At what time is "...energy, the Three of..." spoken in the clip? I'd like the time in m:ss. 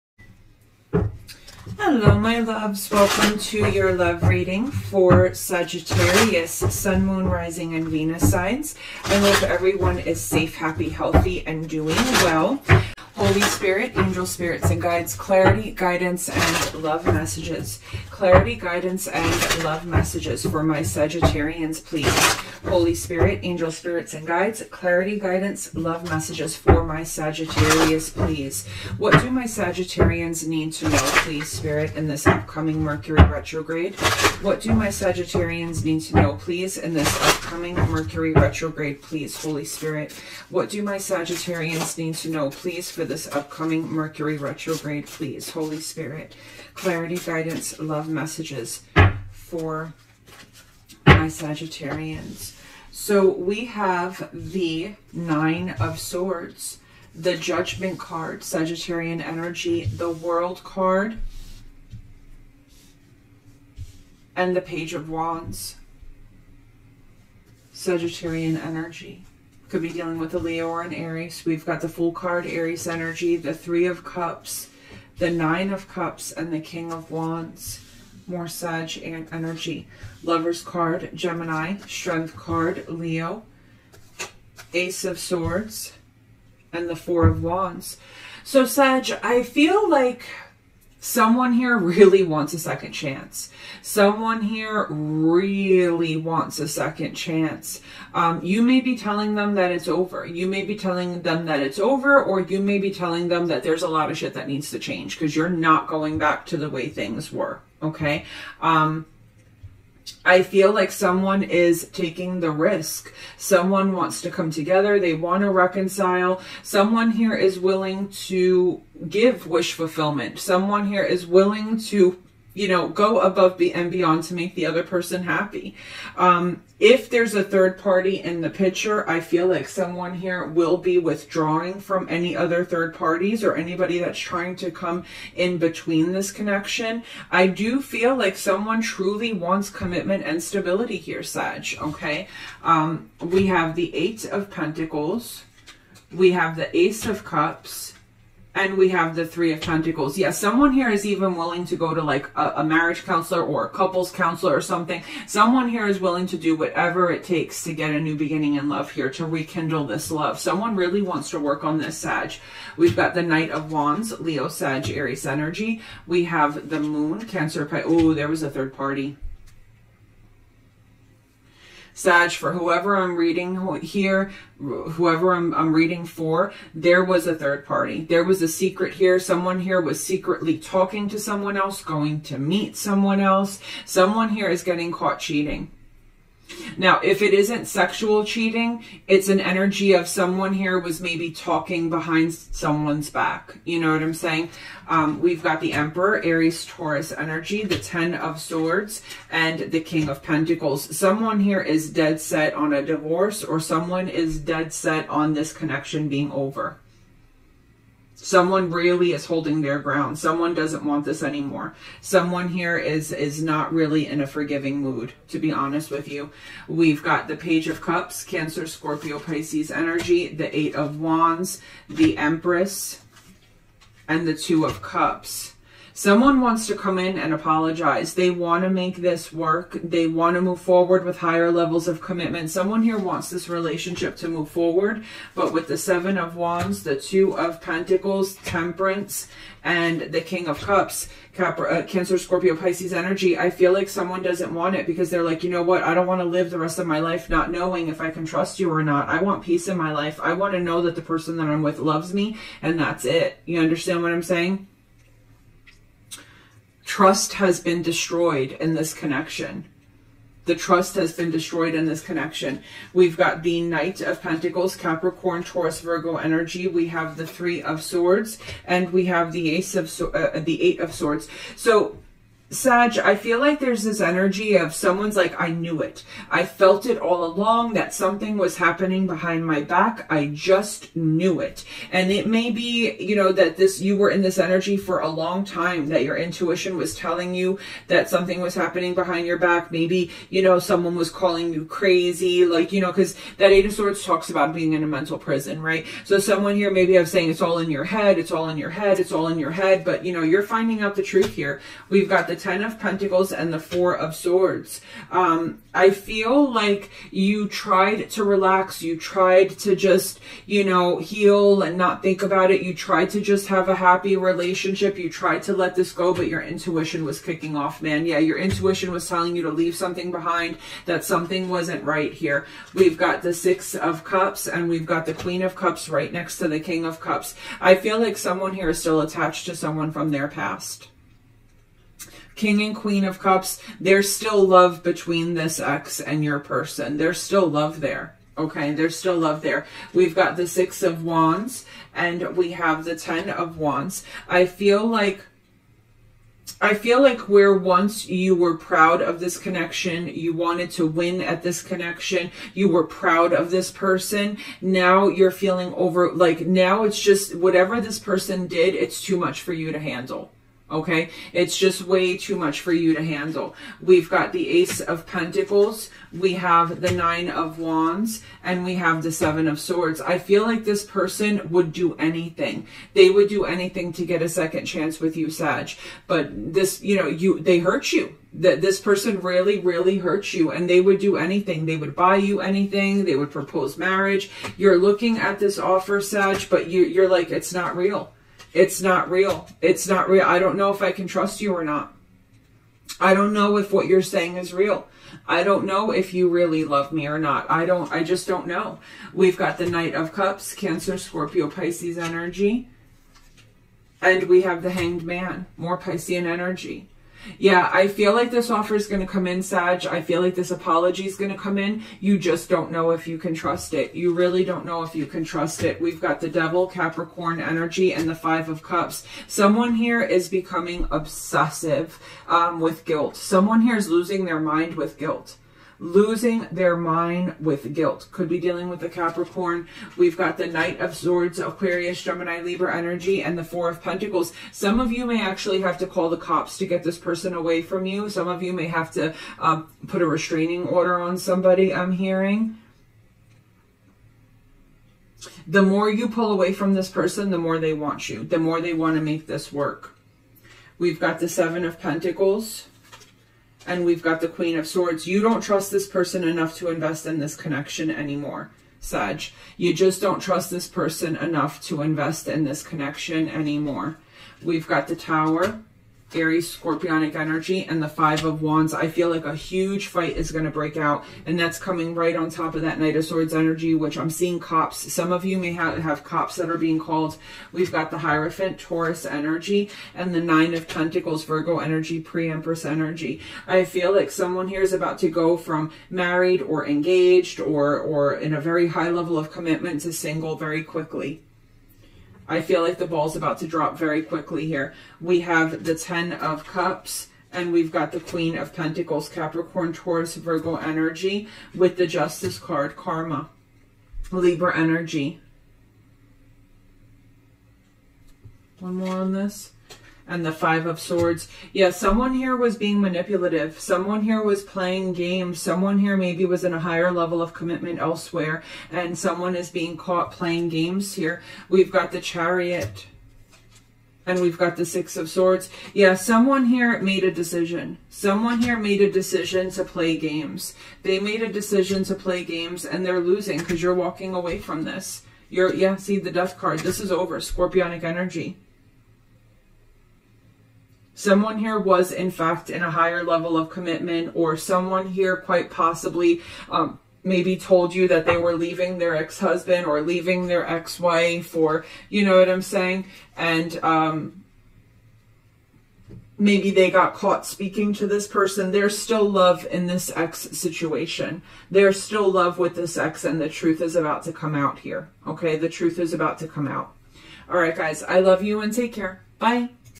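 1:12.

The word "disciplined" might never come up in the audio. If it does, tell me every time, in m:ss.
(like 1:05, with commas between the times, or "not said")
not said.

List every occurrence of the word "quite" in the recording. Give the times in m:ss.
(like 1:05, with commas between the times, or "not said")
9:05.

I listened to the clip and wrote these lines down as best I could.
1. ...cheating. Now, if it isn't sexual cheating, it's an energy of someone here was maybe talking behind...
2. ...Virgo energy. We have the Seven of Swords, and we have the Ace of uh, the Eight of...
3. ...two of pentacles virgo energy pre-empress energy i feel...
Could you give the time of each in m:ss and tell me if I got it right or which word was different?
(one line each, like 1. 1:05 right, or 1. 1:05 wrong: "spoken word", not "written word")
1. 3:05 right
2. 4:25 wrong: "Three", not "Seven"
3. 8:00 wrong: "nine", not "two".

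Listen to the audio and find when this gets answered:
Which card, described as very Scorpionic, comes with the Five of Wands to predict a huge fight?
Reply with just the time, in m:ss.
7:44.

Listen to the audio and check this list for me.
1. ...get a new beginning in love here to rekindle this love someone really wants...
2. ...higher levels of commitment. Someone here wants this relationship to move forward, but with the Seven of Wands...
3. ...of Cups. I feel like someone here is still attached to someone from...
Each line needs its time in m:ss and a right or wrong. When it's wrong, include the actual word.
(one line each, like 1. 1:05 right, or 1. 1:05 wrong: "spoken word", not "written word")
1. 2:37 right
2. 3:51 right
3. 5:26 right.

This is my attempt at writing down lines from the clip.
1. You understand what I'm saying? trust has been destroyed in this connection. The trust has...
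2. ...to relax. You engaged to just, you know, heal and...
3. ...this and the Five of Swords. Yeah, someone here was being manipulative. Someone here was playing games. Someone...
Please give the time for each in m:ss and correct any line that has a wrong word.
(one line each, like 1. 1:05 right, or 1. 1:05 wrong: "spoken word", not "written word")
1. 4:13 right
2. 5:08 wrong: "tried", not "engaged"
3. 8:29 right.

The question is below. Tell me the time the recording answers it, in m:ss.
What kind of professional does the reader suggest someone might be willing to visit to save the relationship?
2:32.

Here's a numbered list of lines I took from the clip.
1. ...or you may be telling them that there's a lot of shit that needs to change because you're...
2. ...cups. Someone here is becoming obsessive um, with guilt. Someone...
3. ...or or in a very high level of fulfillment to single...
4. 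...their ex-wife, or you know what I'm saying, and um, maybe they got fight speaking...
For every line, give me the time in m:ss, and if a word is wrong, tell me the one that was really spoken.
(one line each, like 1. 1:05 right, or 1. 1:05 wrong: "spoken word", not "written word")
1. 1:42 right
2. 6:58 right
3. 8:07 wrong: "commitment", not "fulfillment"
4. 9:10 wrong: "caught", not "fight".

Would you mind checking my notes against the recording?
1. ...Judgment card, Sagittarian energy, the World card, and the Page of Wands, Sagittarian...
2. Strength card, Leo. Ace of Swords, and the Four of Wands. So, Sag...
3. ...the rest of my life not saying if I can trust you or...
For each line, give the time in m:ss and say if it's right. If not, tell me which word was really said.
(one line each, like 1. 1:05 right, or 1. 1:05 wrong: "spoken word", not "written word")
1. 0:57 right
2. 1:21 right
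3. 4:06 wrong: "knowing", not "saying".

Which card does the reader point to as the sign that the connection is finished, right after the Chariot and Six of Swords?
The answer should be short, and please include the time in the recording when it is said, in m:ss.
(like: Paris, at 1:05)
Death, at 8:56.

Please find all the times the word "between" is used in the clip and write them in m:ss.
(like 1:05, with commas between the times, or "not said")
2:15, 5:34.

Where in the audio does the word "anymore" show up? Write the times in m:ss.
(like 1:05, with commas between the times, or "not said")
3:31, 7:37, 7:43.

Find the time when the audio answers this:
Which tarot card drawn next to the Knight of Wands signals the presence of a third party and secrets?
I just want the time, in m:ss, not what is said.
2:46.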